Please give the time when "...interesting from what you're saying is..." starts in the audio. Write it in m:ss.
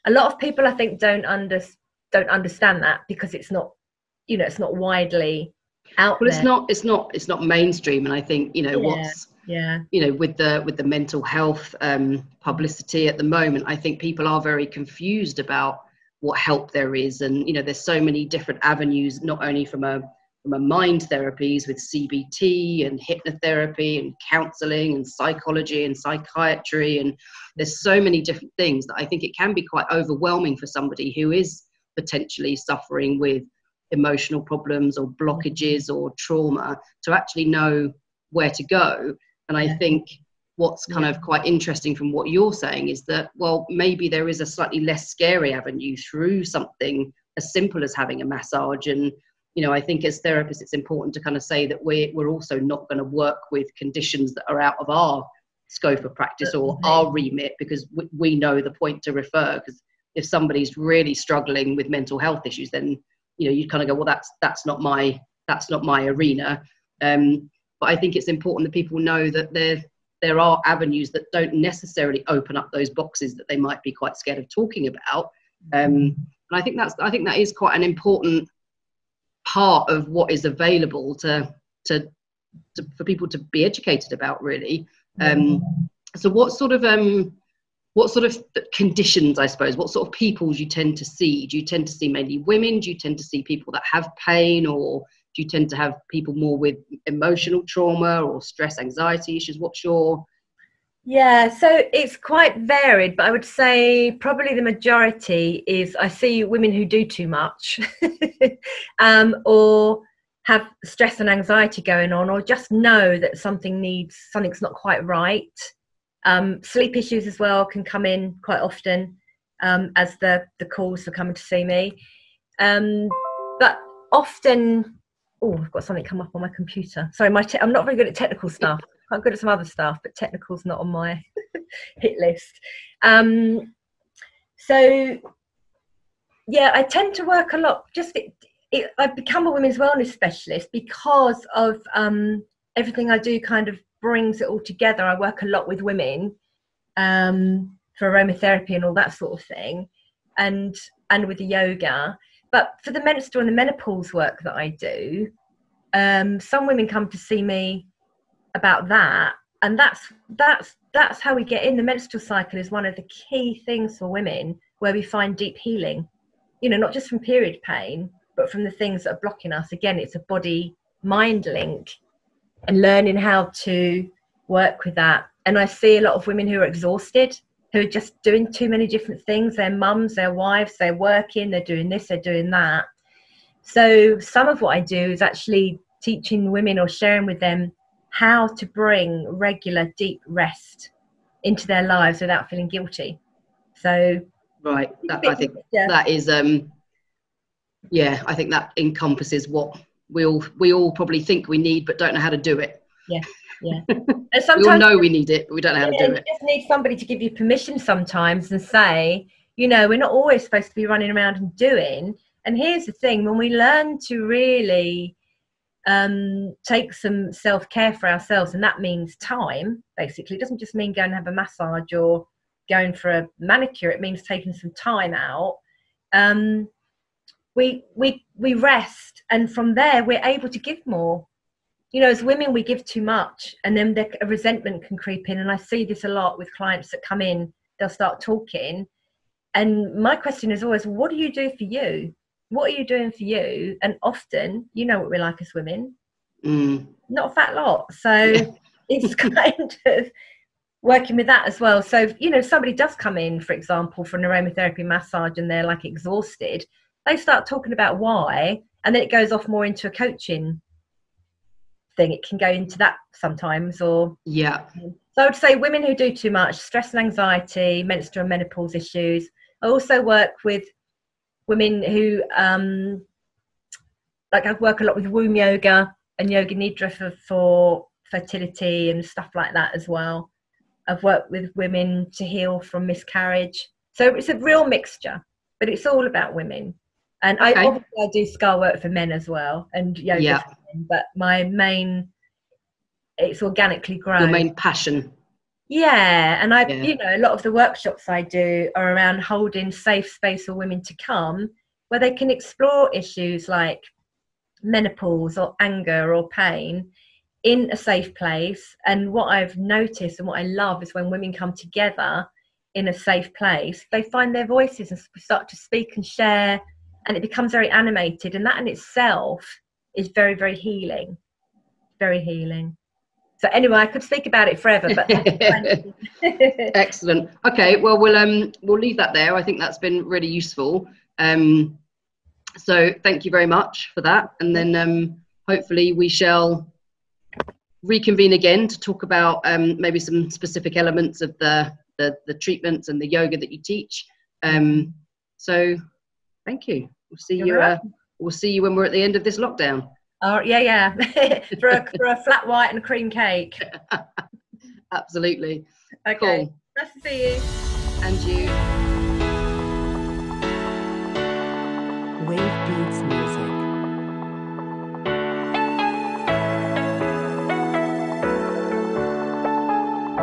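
0:41.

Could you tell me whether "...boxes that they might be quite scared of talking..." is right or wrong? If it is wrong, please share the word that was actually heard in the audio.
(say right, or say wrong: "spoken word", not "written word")
right.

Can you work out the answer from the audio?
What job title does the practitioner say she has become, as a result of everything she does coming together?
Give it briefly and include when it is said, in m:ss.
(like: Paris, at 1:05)
women's wellness specialist, at 2:19.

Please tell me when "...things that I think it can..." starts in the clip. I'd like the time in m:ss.
0:28.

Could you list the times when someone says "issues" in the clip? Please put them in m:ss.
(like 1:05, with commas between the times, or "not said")
1:02, 1:39, 1:56, 4:28, 5:02.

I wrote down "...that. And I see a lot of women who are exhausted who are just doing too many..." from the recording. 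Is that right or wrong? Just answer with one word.
right.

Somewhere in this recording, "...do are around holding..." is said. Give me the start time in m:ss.
4:58.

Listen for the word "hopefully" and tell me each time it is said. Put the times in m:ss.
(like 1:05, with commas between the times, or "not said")
5:35.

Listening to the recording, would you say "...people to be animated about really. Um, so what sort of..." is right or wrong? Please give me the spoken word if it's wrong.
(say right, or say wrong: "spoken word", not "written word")
wrong: "educated", not "animated".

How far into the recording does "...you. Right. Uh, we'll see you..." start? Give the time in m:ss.
5:47.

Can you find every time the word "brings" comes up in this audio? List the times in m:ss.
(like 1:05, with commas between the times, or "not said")
2:24, 3:08.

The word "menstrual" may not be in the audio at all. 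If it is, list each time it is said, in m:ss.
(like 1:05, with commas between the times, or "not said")
2:33, 2:41, 4:27.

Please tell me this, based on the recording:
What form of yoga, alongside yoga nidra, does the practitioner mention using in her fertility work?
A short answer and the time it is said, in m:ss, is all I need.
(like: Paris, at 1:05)
womb yoga, at 4:35.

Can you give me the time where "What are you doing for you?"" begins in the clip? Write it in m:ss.
4:02.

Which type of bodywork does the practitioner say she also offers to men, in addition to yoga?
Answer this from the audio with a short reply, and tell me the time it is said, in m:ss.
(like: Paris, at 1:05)
scar work, at 4:48.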